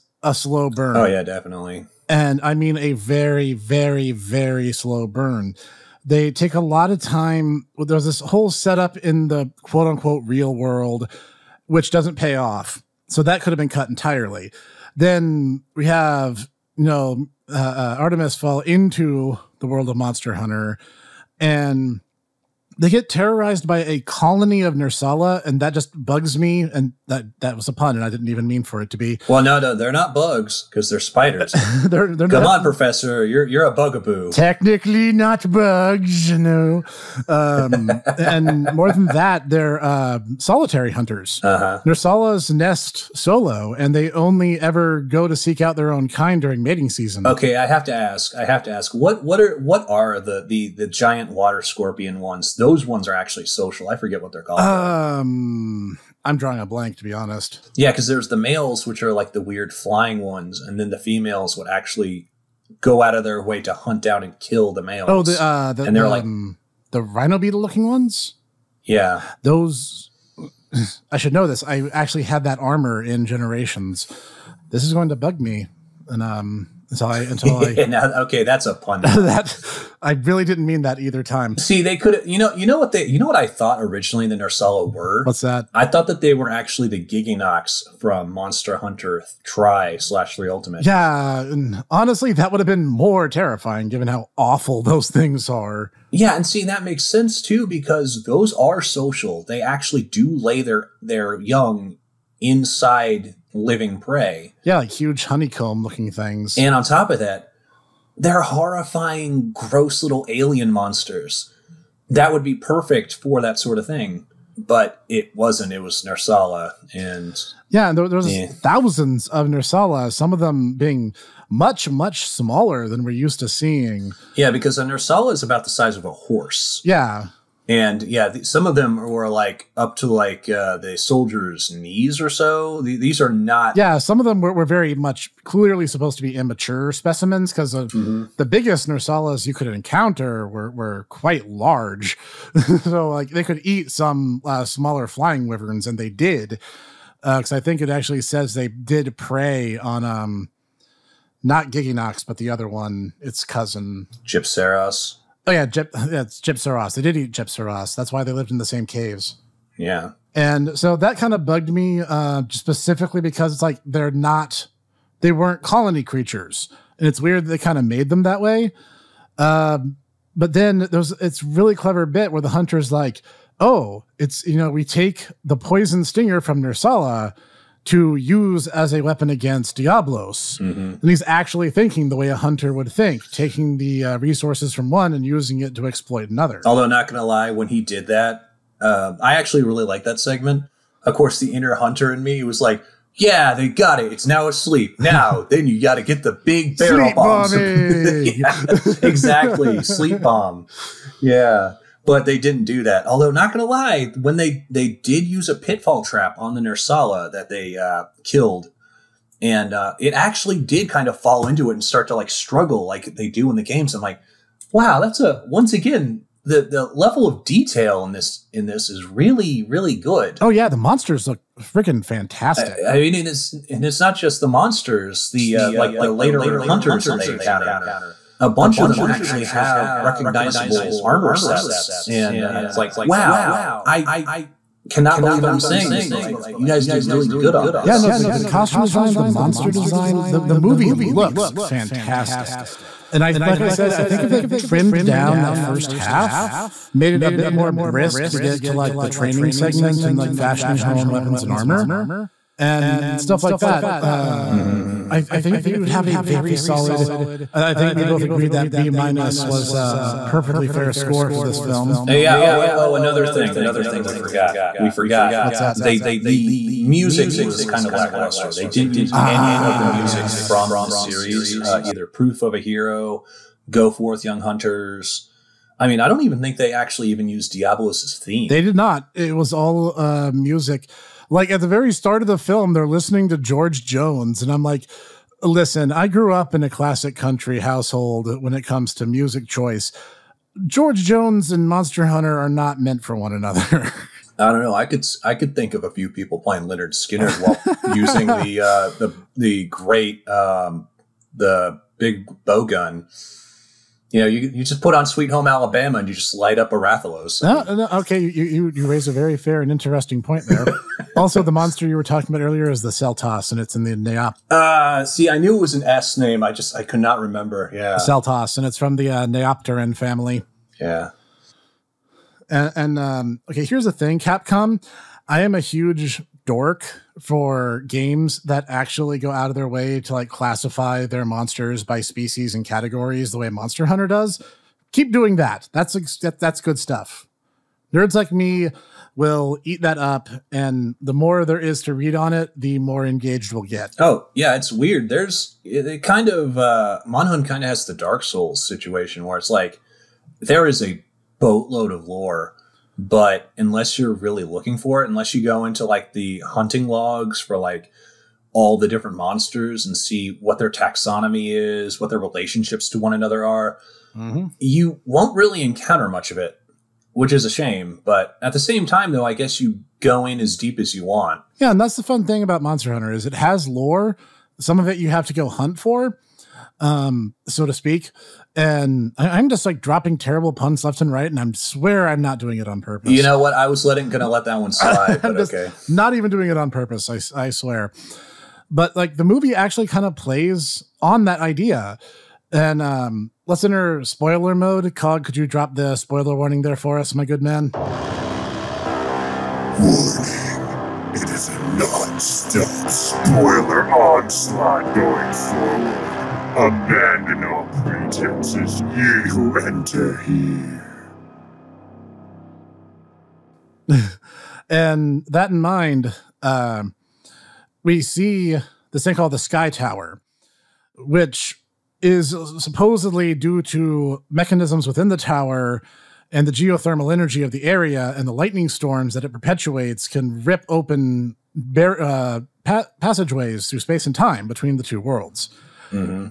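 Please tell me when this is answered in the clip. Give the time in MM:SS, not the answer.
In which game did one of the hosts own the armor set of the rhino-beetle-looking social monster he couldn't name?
01:13.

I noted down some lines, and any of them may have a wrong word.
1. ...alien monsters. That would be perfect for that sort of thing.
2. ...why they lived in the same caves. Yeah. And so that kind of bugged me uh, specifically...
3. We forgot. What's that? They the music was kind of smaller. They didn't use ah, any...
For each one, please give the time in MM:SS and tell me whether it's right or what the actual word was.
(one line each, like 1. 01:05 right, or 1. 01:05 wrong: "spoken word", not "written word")
1. 01:50 right
2. 02:38 right
3. 04:24 wrong: "lackluster", not "smaller".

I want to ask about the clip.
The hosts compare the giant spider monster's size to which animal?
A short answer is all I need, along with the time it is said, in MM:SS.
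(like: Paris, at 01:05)
A horse, at 02:05.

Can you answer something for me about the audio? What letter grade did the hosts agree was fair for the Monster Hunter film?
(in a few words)
B minus.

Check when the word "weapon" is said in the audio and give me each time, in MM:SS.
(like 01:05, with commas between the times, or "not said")
02:59, 04:11.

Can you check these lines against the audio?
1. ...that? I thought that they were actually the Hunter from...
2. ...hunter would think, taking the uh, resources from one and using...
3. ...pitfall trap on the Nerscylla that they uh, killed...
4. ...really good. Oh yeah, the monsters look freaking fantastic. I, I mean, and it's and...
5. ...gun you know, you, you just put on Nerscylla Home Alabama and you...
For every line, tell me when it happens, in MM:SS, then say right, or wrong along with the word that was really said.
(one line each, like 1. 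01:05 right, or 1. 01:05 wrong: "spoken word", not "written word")
1. 01:25 wrong: "Gigginox", not "Hunter"
2. 03:02 right
3. 03:25 right
4. 03:39 right
5. 05:02 wrong: "Sweet", not "Nerscylla".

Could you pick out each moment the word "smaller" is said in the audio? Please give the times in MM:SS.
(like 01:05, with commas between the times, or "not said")
02:02, 02:24.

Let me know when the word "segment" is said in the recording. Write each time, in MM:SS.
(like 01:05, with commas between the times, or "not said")
03:10, 04:09.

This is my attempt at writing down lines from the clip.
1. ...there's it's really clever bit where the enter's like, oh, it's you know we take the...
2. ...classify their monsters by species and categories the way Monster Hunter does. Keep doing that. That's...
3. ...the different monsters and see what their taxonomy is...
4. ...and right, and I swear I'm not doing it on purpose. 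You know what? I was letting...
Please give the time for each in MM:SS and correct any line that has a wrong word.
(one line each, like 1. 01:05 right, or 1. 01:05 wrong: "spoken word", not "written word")
1. 02:50 wrong: "hunter", not "enter"
2. 05:30 right
3. 05:58 right
4. 06:21 right.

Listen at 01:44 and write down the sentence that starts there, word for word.
Yeah, like huge honeycomb looking things.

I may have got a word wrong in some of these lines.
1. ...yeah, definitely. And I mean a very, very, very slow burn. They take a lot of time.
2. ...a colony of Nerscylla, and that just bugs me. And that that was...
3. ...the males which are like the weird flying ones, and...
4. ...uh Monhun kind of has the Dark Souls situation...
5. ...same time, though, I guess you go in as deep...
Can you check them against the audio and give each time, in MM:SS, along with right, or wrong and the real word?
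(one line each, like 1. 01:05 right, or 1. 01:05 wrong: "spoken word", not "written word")
1. 00:01 right
2. 00:23 right
3. 00:58 right
4. 05:46 right
5. 06:08 right.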